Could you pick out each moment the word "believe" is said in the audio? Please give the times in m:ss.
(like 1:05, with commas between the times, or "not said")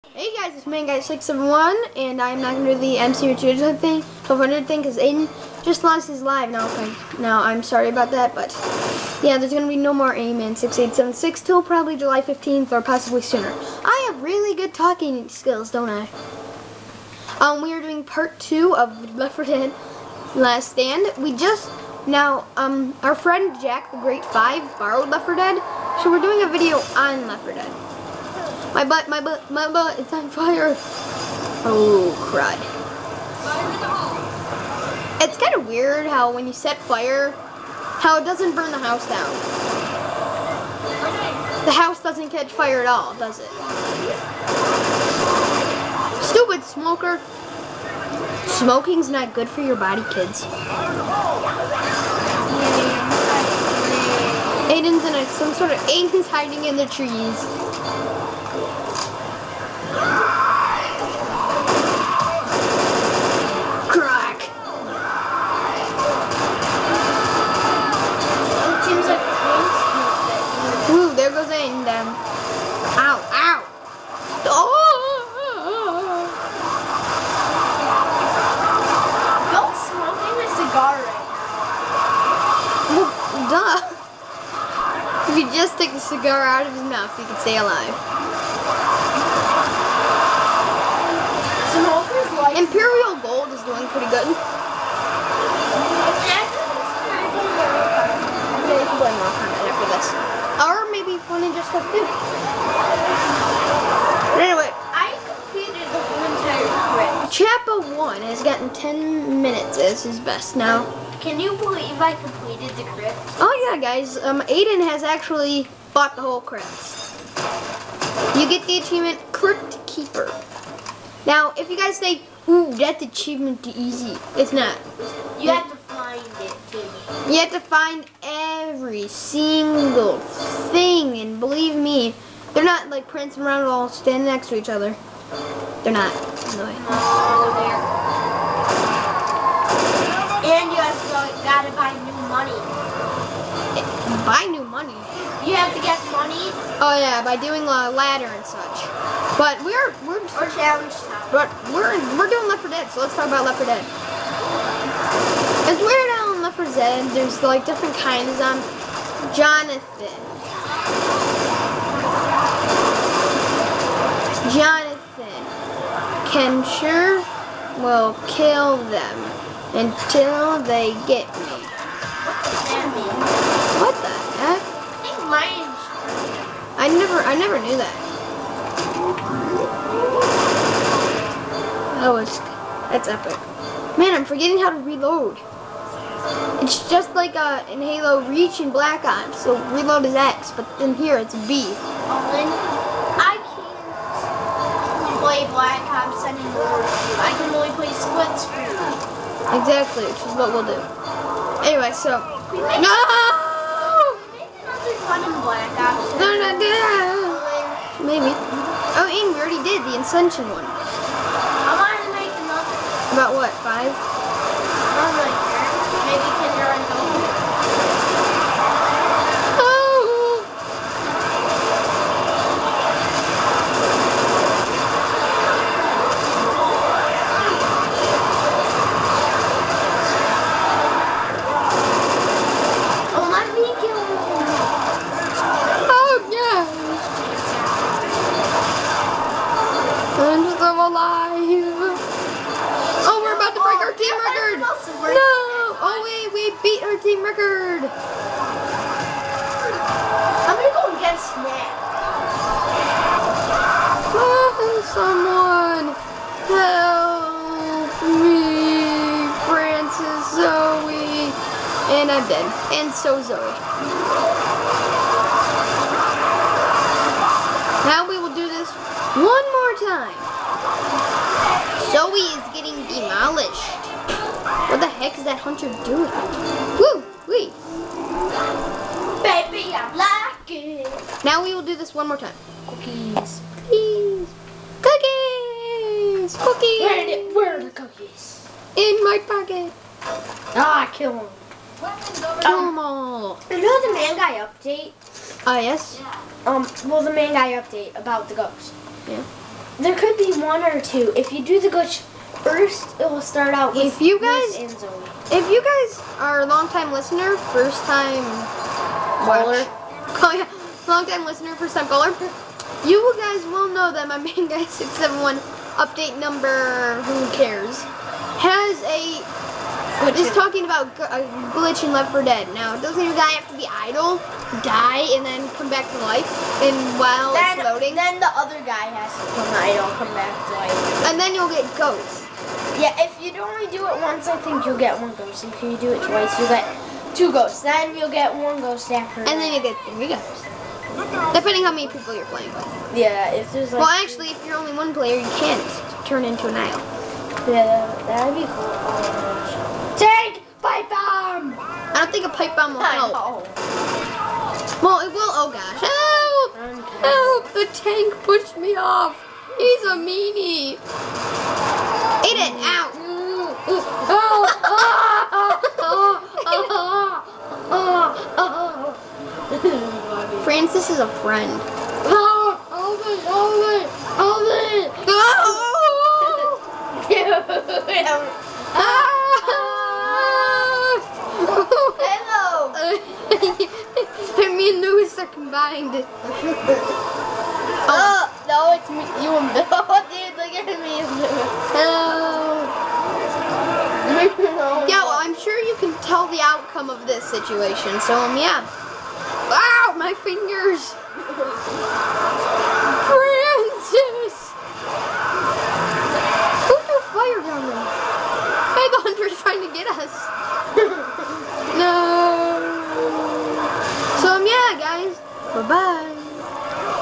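1:51, 2:11.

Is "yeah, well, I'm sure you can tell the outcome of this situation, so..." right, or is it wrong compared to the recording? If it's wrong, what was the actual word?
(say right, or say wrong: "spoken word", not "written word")
right.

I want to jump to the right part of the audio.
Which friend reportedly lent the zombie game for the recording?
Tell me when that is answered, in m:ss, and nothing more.
0:23.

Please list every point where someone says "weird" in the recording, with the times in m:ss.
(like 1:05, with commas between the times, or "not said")
0:35, 2:35.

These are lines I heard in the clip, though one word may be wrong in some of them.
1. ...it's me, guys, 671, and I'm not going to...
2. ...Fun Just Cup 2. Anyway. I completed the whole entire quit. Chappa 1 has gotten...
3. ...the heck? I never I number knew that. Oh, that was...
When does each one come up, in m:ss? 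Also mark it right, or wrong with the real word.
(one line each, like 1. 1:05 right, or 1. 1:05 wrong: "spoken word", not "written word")
1. 0:00 right
2. 1:41 right
3. 2:53 wrong: "never", not "number".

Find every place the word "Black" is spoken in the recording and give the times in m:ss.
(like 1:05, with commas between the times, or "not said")
3:08, 3:15.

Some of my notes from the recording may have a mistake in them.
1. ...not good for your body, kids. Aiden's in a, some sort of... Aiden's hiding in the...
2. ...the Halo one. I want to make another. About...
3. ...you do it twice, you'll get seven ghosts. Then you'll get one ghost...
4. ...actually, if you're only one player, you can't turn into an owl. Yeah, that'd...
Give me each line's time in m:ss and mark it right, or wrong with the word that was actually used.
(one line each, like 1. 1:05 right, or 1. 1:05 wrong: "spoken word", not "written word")
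1. 0:49 right
2. 3:29 wrong: "Ascension", not "Halo"
3. 5:35 wrong: "two", not "seven"
4. 5:44 right.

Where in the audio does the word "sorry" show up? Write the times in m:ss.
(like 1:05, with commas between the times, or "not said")
0:07.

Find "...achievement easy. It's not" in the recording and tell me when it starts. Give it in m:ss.
2:03.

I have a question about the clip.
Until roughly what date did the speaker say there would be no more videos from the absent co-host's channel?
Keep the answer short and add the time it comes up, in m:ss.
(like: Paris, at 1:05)
July 15th, at 0:11.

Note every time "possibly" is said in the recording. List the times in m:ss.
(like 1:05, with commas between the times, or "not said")
0:12.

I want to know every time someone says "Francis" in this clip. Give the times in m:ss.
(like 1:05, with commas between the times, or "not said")
4:19, 6:10.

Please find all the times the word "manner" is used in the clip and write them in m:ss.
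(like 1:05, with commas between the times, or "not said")
not said.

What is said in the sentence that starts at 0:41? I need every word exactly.
The house doesn't catch fire at all, does it?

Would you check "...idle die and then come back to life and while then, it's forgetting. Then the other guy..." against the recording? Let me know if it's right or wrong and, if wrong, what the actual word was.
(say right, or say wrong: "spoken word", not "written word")
wrong: "loading", not "forgetting".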